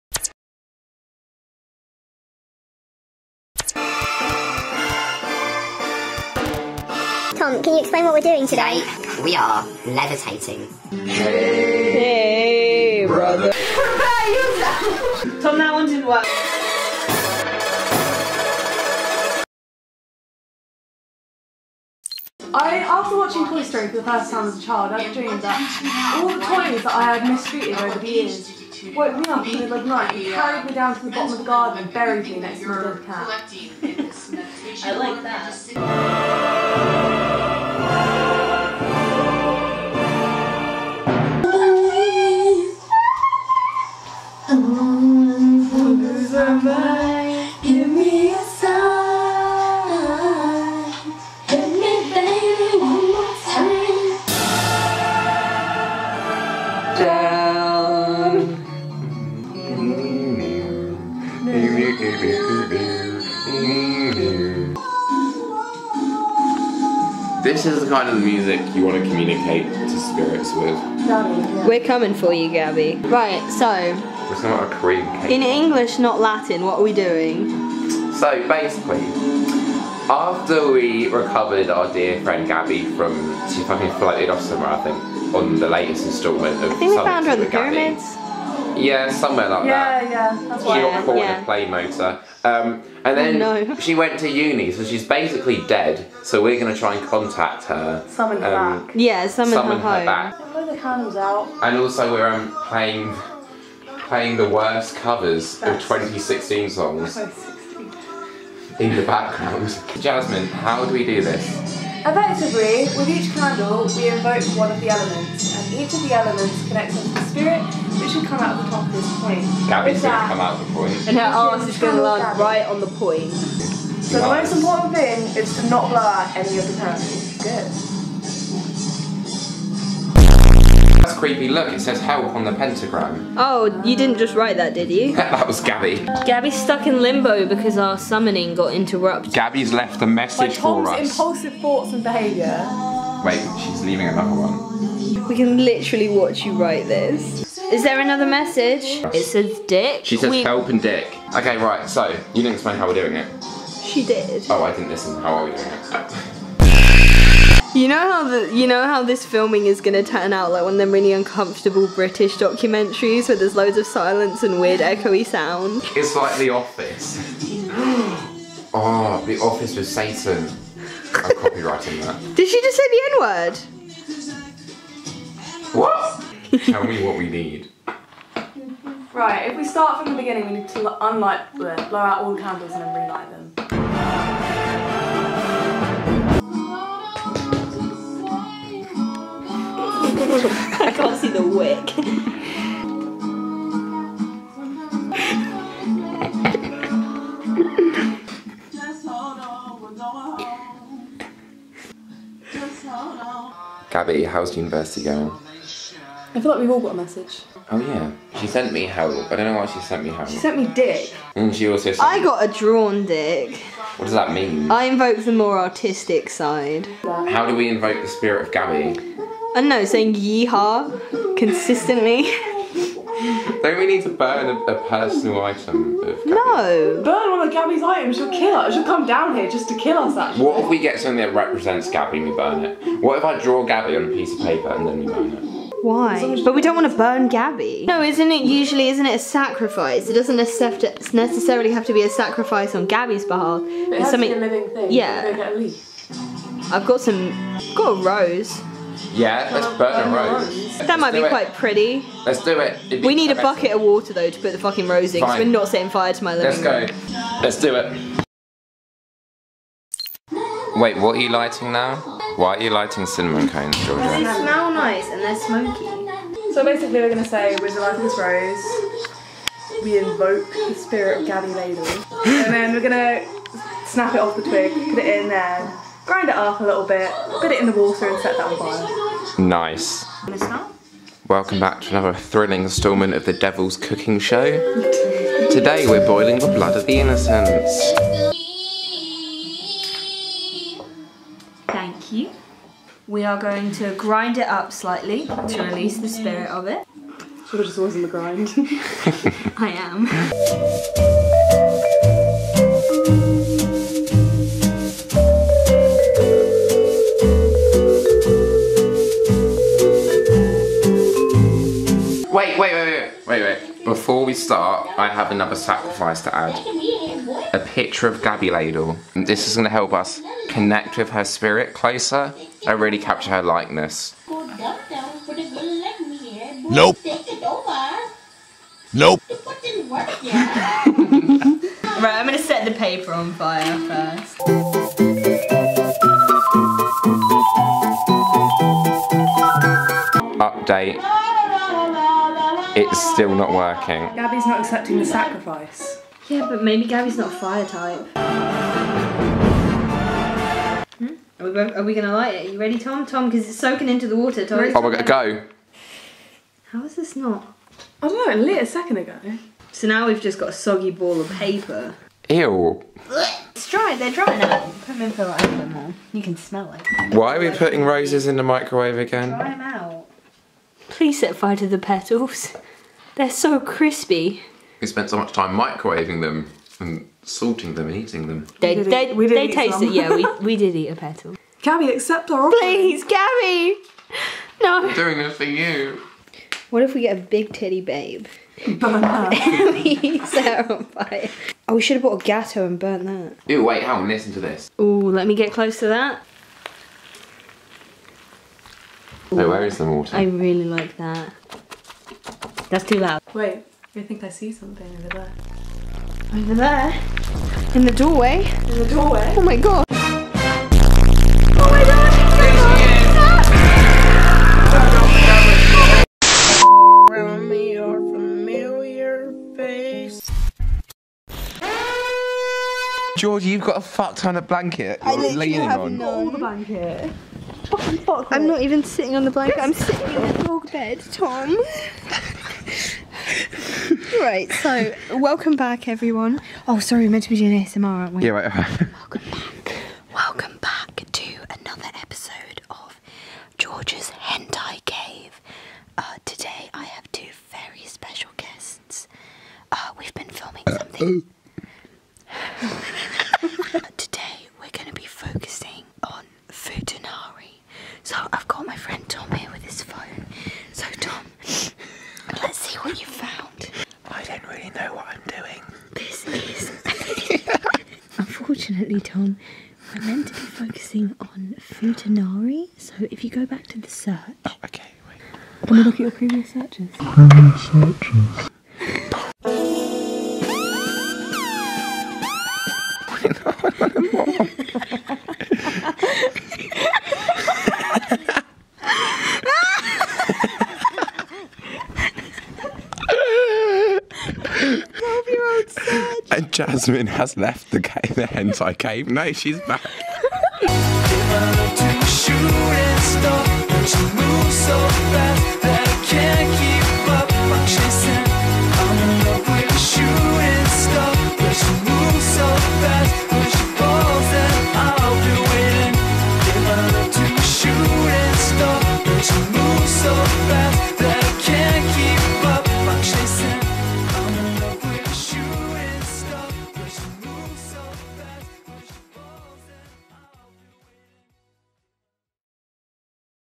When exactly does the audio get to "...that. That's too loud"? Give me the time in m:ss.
6:40.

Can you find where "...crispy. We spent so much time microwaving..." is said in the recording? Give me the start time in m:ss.
6:13.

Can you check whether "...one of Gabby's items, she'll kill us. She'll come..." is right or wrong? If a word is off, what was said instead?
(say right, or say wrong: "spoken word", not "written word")
right.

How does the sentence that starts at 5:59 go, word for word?
So now we've just got a soggy ball of paper.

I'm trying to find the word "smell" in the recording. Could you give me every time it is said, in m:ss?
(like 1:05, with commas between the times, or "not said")
4:23, 6:06.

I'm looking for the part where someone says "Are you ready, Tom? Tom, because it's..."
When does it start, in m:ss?
5:52.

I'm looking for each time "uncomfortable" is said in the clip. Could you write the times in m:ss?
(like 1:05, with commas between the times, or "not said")
2:41.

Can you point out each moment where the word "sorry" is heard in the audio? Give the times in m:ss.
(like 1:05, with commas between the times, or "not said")
7:16.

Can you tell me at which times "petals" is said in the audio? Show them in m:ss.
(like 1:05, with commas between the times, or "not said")
6:11, 6:20.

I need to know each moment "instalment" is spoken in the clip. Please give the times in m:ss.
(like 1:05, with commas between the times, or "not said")
1:26, 4:42.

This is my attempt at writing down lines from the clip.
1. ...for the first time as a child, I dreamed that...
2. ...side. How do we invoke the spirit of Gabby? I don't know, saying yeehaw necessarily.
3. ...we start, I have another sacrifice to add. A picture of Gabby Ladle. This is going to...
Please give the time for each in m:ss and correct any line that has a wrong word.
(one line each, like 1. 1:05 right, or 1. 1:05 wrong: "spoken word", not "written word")
1. 0:23 right
2. 3:36 wrong: "consistently", not "necessarily"
3. 5:14 right.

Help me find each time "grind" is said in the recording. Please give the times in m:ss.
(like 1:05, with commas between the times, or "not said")
4:36, 4:53, 4:58.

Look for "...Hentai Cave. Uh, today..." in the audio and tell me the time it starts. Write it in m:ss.
7:24.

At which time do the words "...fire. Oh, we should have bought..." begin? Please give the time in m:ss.
6:30.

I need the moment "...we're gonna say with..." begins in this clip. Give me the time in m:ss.
4:27.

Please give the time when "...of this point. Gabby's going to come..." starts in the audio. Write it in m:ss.
1:58.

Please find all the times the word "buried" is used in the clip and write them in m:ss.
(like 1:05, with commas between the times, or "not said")
0:31.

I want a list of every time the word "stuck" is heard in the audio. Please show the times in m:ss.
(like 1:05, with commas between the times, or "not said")
2:16.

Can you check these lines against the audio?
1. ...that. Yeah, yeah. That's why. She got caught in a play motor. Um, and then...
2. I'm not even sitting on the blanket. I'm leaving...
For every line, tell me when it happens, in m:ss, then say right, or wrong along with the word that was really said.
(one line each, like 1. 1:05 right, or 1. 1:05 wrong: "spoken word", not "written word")
1. 1:30 right
2. 7:08 wrong: "sitting", not "leaving".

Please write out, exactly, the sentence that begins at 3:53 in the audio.
What if I draw Gabby on a piece of paper and then we burn it?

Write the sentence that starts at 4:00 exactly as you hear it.
It doesn't necessarily have to be a sacrifice on Gabby's behalf.